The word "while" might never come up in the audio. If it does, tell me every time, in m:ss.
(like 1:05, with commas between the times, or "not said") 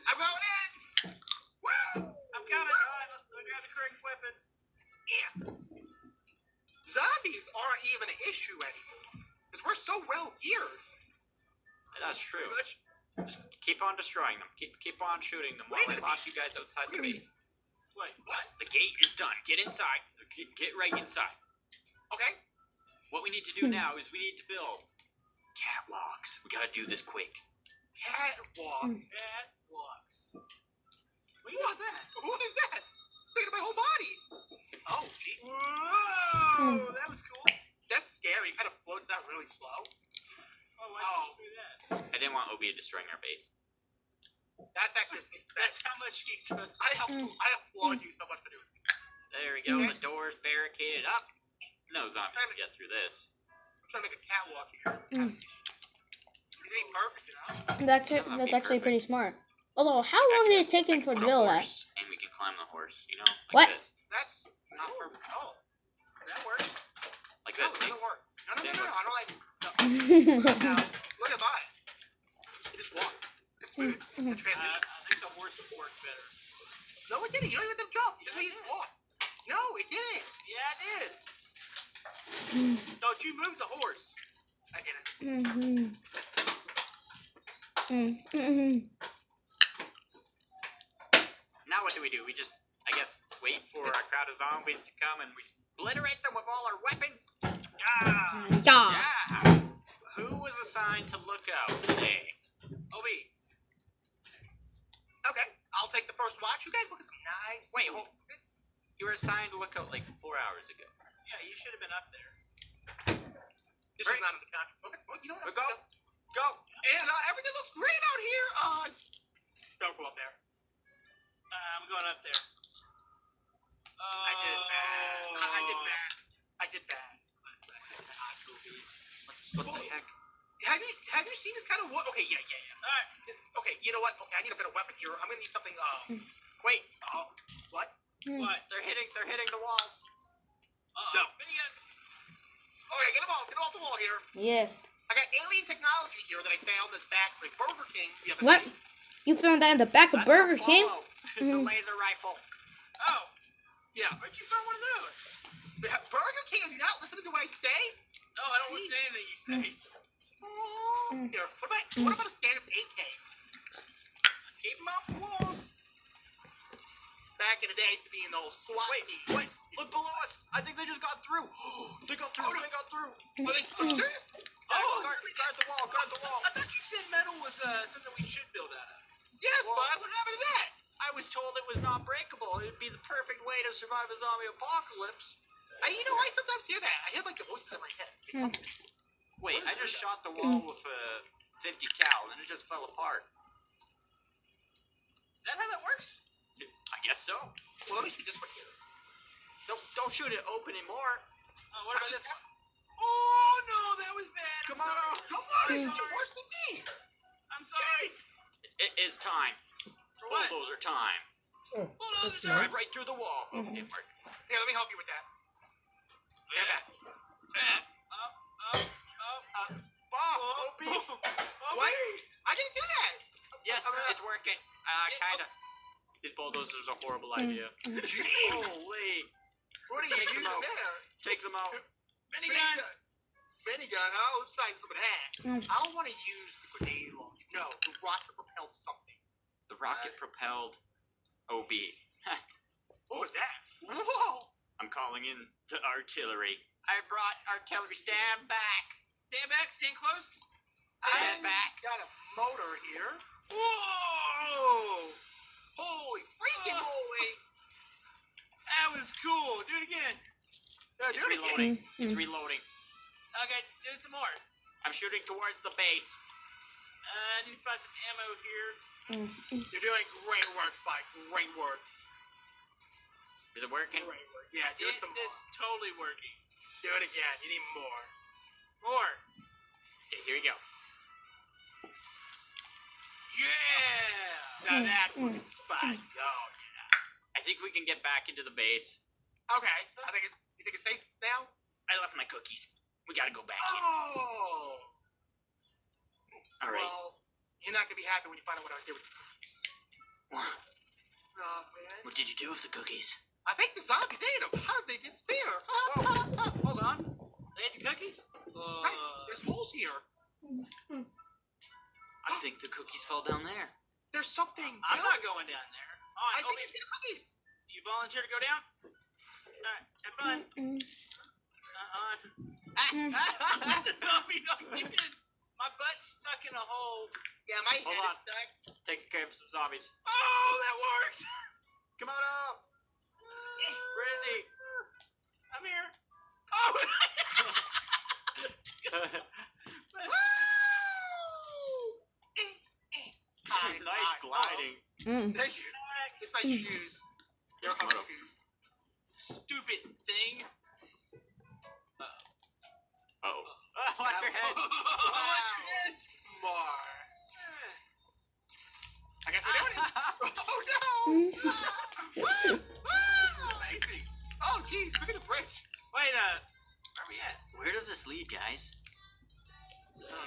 0:15.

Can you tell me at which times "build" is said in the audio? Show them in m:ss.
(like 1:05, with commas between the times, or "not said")
0:24, 1:01, 2:58.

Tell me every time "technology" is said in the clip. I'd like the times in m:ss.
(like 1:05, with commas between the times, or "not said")
2:25.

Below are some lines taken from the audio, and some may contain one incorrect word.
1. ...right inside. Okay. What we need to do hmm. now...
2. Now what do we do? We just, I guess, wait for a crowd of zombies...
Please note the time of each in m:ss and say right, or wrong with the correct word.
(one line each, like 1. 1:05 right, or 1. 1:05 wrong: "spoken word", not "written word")
1. 0:20 right
2. 1:31 right.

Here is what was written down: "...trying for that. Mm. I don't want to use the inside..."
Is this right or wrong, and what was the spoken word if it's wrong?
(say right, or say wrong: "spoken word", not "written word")
wrong: "grenade", not "inside".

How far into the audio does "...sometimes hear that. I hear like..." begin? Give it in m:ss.
3:06.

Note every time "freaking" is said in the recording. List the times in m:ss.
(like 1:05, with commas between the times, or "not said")
4:16.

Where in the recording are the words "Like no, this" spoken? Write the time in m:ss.
1:07.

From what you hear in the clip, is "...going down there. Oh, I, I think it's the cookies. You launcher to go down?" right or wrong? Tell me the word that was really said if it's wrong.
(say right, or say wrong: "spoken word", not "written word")
wrong: "volunteer", not "launcher".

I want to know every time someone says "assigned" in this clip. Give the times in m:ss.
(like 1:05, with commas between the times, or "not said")
1:40, 1:49.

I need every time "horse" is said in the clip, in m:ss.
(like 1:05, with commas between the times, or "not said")
1:02, 1:15, 1:23.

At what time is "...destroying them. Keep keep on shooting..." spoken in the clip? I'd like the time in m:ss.
0:13.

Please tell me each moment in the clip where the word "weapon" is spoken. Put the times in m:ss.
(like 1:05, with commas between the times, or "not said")
0:04, 1:36, 2:14.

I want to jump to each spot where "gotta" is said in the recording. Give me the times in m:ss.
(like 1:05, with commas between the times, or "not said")
0:26, 4:53.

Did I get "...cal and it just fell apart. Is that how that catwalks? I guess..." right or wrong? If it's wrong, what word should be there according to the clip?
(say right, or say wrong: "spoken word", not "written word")
wrong: "works", not "catwalks".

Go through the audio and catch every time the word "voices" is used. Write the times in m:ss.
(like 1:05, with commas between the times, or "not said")
3:07.